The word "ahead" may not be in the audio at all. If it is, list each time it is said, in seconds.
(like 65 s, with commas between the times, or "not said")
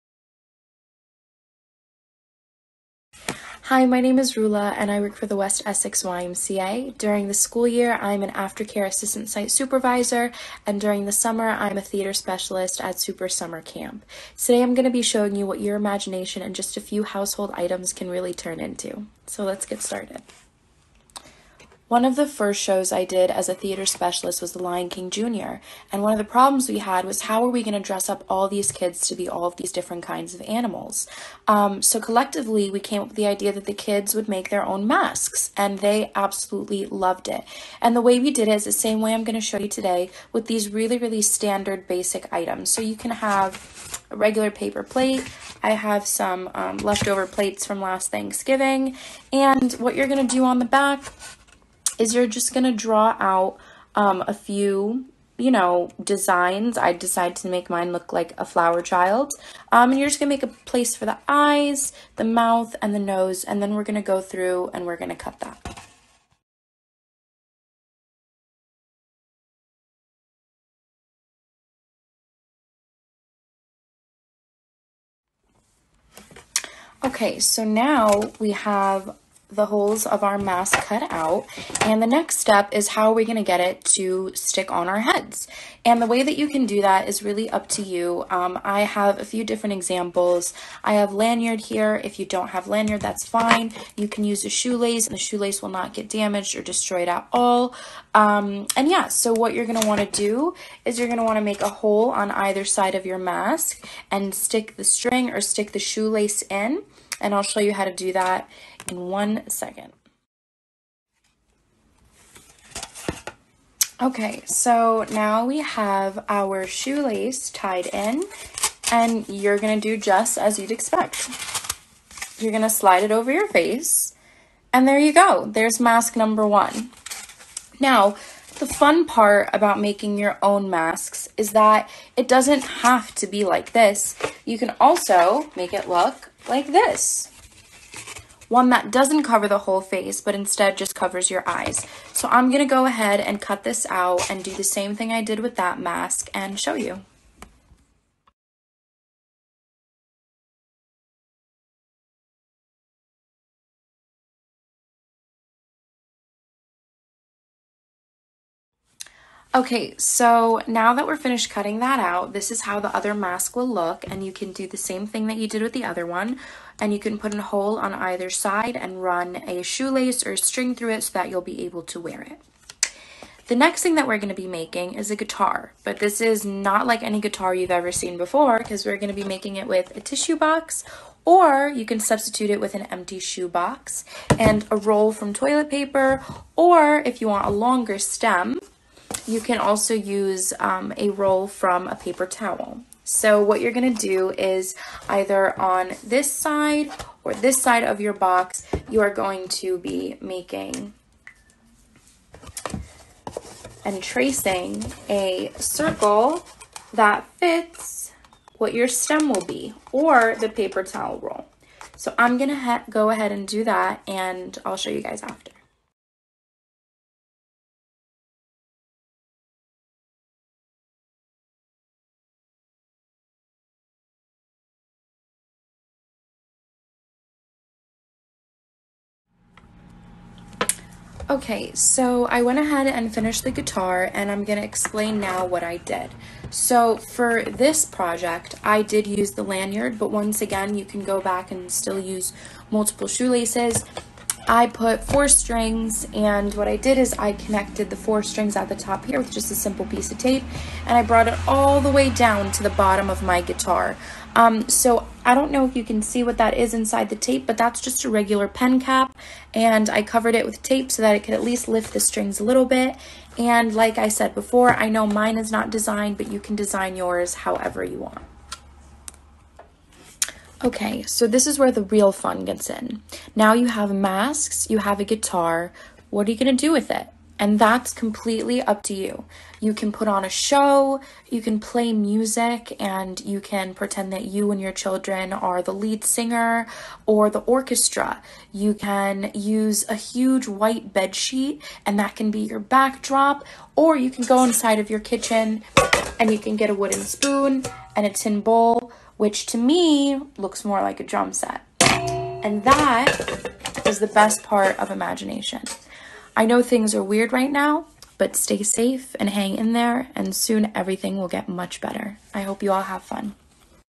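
142 s, 213 s, 232 s.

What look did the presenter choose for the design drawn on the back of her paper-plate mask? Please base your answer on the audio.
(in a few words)
flower child.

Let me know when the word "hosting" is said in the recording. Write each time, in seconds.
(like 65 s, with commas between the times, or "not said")
not said.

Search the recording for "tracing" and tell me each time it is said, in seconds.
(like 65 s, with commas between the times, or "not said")
204 s.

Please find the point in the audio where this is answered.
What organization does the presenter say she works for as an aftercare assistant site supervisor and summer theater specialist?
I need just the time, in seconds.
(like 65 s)
5 s.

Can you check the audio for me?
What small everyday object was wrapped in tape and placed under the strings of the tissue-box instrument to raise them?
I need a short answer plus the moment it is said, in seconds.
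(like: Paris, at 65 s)
pen cap, at 258 s.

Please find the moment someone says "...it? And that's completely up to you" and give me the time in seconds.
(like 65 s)
276 s.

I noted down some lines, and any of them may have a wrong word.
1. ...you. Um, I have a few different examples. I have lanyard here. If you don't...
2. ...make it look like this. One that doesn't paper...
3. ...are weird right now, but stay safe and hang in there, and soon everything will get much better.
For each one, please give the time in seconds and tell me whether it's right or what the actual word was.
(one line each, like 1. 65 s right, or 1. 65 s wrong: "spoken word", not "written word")
1. 87 s right
2. 135 s wrong: "cover", not "paper"
3. 306 s right.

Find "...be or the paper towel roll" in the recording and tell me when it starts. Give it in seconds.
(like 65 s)
209 s.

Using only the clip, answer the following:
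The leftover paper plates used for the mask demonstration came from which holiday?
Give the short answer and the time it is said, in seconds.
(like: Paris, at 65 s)
Thanksgiving, at 48 s.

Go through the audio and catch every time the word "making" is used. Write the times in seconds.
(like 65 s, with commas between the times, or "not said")
129 s, 174 s, 179 s, 200 s.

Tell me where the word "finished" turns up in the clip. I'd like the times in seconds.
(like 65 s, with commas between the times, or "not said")
161 s, 233 s.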